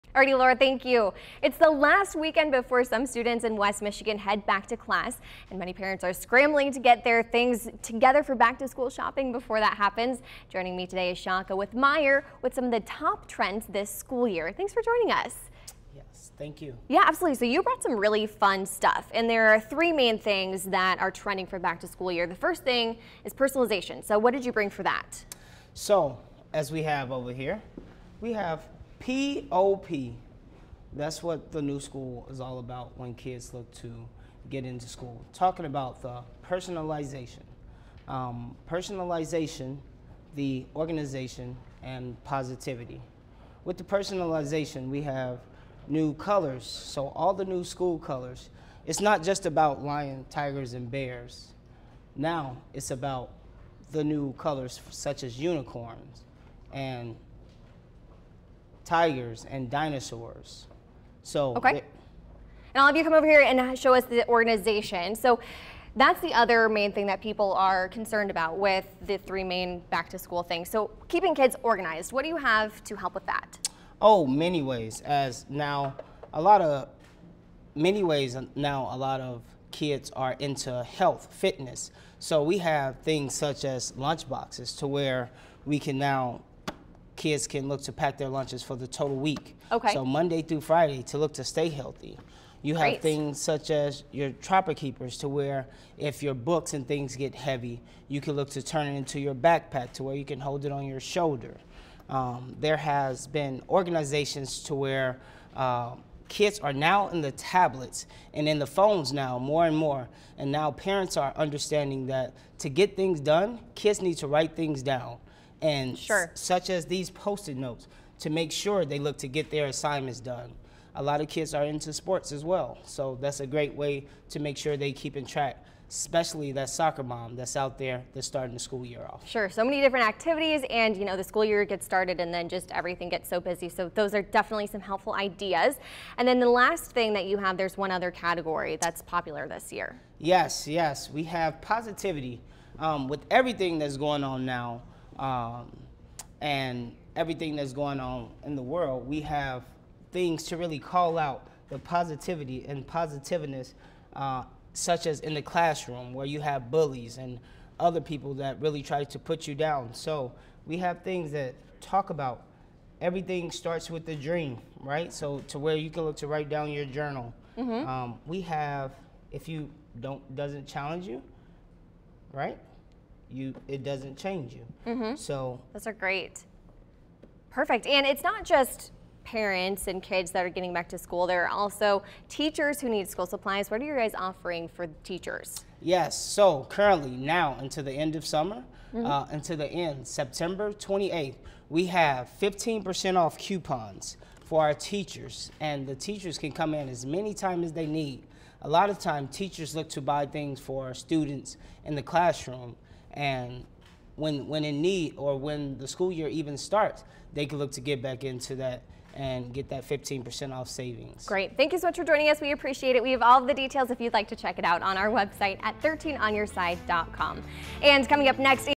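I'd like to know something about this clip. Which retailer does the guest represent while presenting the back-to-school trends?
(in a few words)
Meijer.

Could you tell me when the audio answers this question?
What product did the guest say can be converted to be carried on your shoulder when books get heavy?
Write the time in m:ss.
1:34.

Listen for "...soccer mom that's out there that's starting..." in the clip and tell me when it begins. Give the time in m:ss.
2:06.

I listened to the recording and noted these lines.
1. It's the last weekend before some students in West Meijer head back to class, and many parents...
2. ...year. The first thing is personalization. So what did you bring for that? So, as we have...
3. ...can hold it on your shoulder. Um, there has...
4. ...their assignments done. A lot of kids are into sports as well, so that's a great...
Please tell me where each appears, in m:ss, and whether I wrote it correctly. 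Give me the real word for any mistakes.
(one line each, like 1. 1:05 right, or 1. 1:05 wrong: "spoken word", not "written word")
1. 0:01 wrong: "Michigan", not "Meijer"
2. 0:22 right
3. 1:40 right
4. 1:59 right.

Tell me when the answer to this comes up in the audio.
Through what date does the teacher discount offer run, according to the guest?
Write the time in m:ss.
3:10.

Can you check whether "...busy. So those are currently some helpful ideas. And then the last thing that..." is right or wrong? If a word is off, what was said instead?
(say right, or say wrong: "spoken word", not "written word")
wrong: "definitely", not "currently".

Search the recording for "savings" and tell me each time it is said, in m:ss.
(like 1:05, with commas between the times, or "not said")
3:30.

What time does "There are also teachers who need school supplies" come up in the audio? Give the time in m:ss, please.
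3:01.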